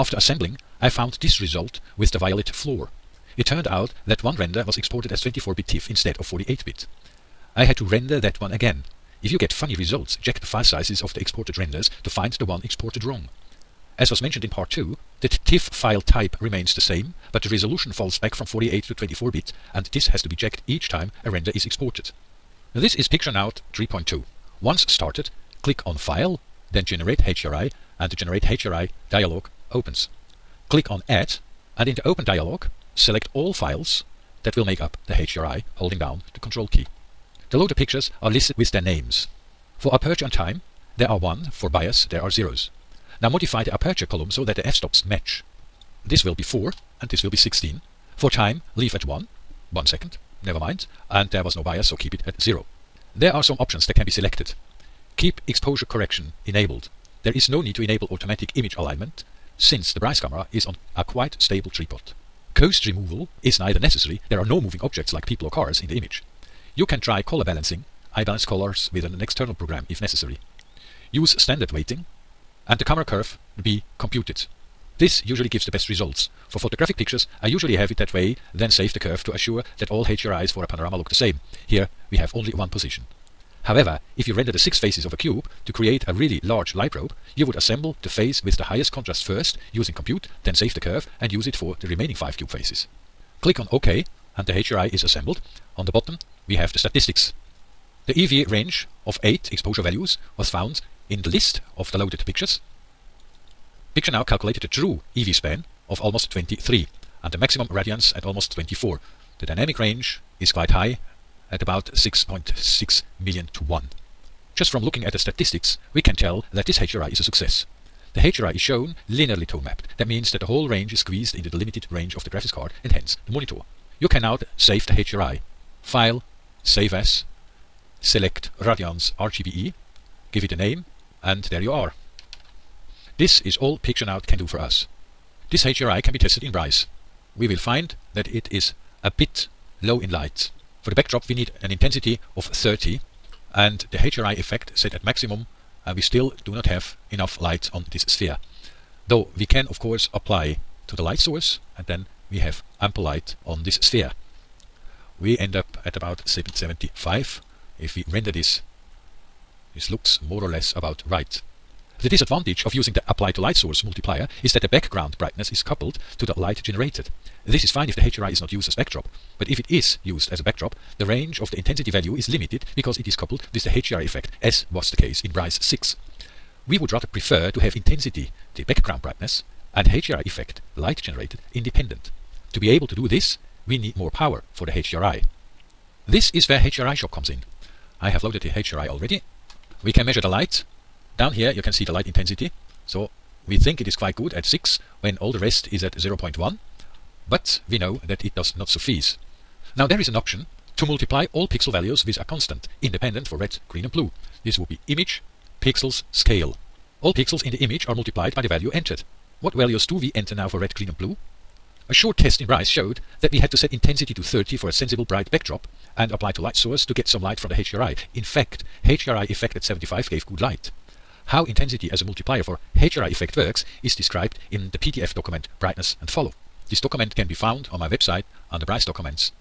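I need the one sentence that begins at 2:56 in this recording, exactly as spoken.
We would rather prefer to have intensity the background brightness and HDRI effect light generated independent.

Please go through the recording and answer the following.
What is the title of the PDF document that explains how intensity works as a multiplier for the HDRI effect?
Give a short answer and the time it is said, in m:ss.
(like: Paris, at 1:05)
Brightness and Falloff, at 3:45.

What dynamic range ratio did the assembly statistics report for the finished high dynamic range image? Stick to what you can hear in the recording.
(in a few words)
about 6.6 million to 1.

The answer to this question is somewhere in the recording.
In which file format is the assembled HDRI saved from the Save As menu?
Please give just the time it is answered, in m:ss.
2:08.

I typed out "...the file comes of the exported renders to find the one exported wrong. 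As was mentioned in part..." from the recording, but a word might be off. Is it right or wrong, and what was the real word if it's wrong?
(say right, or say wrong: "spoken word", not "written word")
wrong: "sizes", not "comes".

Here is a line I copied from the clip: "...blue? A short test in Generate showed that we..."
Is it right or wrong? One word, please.
wrong.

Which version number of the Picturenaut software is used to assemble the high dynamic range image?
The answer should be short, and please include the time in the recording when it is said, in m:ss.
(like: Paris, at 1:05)
3.2, at 0:23.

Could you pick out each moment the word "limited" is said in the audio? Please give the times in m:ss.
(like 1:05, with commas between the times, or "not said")
2:01, 2:52.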